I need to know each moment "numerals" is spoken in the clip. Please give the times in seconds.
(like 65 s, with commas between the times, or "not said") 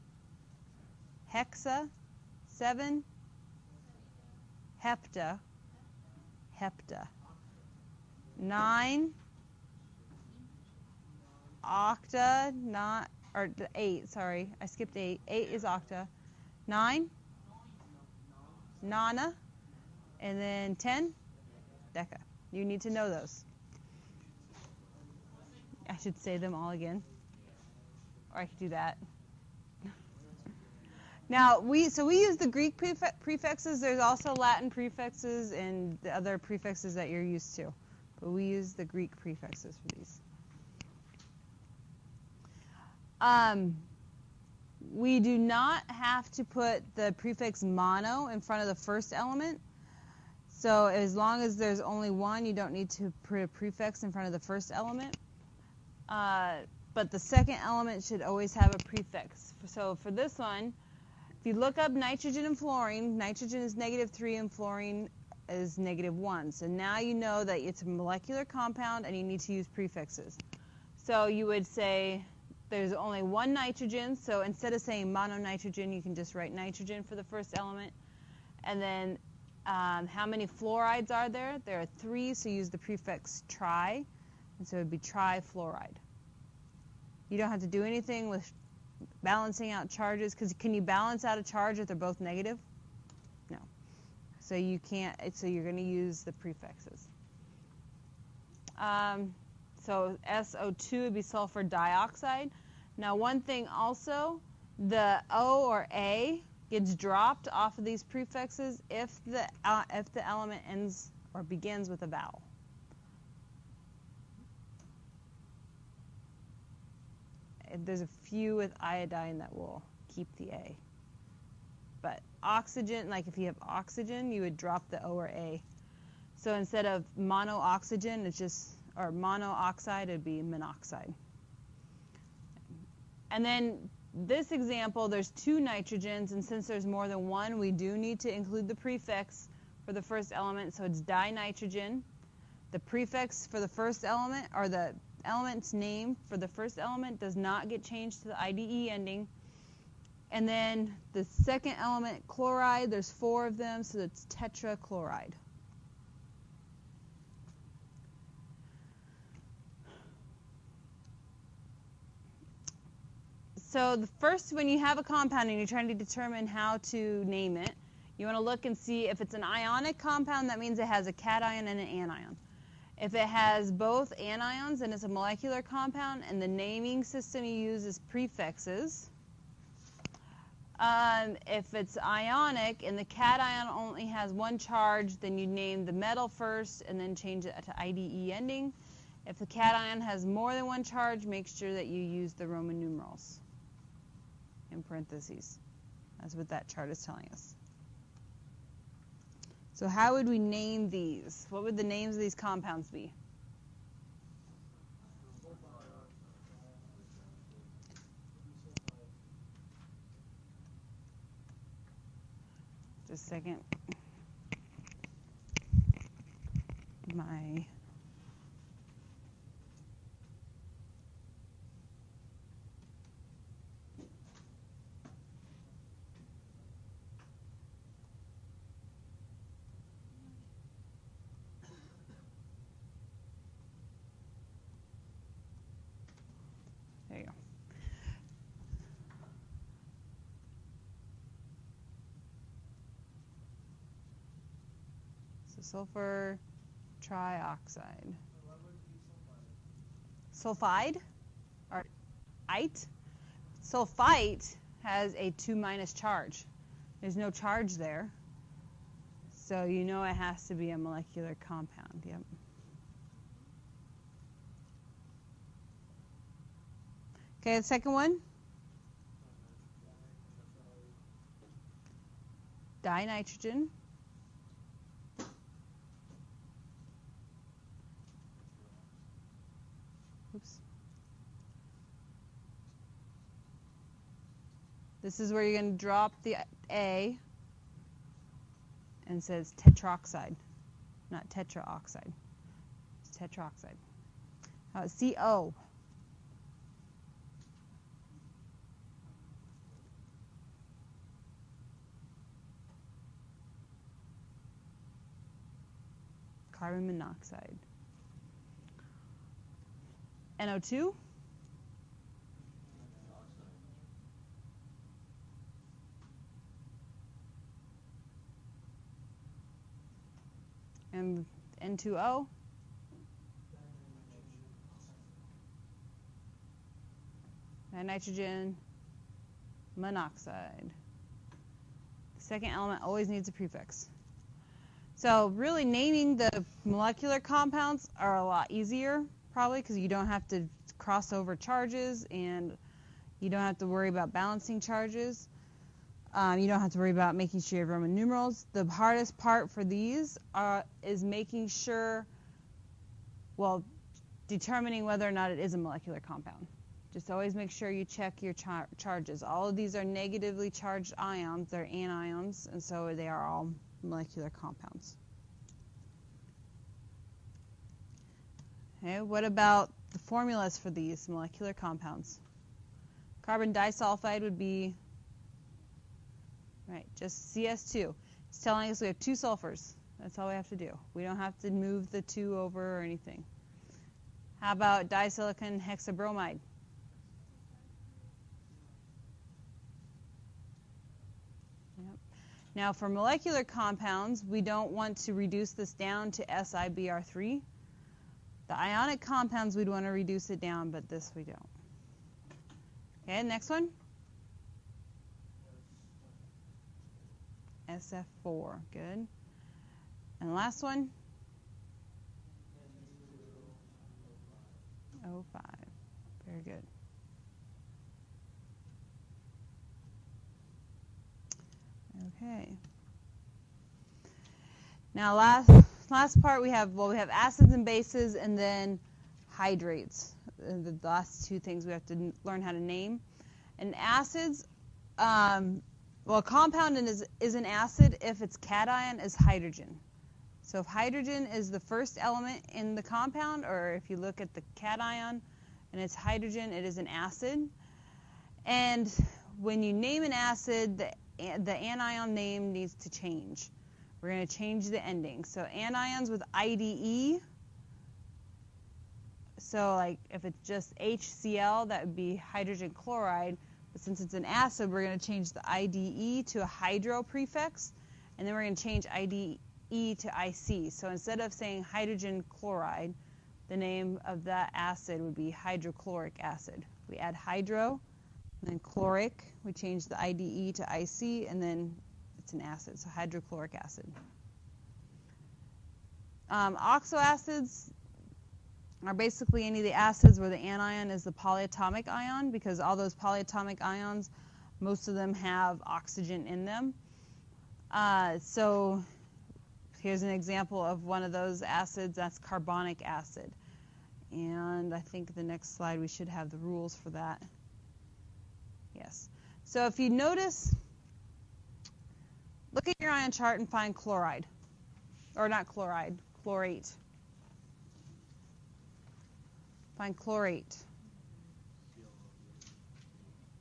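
192 s, 347 s.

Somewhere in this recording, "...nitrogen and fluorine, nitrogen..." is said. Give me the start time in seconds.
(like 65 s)
61 s.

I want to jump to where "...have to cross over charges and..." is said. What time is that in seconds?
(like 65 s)
340 s.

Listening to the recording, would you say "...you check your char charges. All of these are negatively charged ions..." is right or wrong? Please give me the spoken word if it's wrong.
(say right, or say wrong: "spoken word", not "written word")
right.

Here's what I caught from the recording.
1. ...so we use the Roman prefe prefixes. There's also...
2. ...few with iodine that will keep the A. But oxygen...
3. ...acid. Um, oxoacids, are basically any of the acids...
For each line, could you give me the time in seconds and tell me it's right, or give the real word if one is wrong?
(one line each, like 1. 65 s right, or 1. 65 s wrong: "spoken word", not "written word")
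1. 31 s wrong: "Greek", not "Roman"
2. 118 s right
3. 483 s right.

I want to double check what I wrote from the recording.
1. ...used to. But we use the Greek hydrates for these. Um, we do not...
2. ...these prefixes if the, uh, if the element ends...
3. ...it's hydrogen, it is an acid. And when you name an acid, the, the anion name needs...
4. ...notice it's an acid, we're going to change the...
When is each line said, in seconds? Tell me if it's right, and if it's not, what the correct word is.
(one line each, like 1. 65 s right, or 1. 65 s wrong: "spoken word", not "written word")
1. 37 s wrong: "prefixes", not "hydrates"
2. 107 s right
3. 445 s right
4. 463 s wrong: "since", not "notice".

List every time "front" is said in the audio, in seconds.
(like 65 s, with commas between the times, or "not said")
48 s, 54 s.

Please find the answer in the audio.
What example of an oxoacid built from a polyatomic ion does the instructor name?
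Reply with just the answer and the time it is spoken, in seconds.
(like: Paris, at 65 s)
carbonic acid, at 502 s.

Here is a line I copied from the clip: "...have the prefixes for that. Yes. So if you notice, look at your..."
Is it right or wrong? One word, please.
wrong.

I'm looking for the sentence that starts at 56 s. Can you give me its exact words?
Uh, but the second element should always have a prefix.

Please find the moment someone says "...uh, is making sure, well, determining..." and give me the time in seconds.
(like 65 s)
350 s.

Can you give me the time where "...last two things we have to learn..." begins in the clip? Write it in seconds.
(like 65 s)
430 s.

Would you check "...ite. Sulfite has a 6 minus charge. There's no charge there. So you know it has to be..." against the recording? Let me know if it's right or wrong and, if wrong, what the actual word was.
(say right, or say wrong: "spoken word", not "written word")
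wrong: "2", not "6".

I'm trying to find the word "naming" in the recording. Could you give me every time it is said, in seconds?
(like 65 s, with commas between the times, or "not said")
176 s, 335 s.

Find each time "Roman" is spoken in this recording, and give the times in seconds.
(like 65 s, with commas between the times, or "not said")
192 s, 347 s.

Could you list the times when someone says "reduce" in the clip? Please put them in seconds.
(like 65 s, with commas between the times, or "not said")
395 s, 399 s.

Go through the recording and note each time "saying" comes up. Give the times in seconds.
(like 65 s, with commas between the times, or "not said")
74 s, 471 s.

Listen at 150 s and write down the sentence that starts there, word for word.
And then the second element, chloride, there's four of them, so it's tetrachloride.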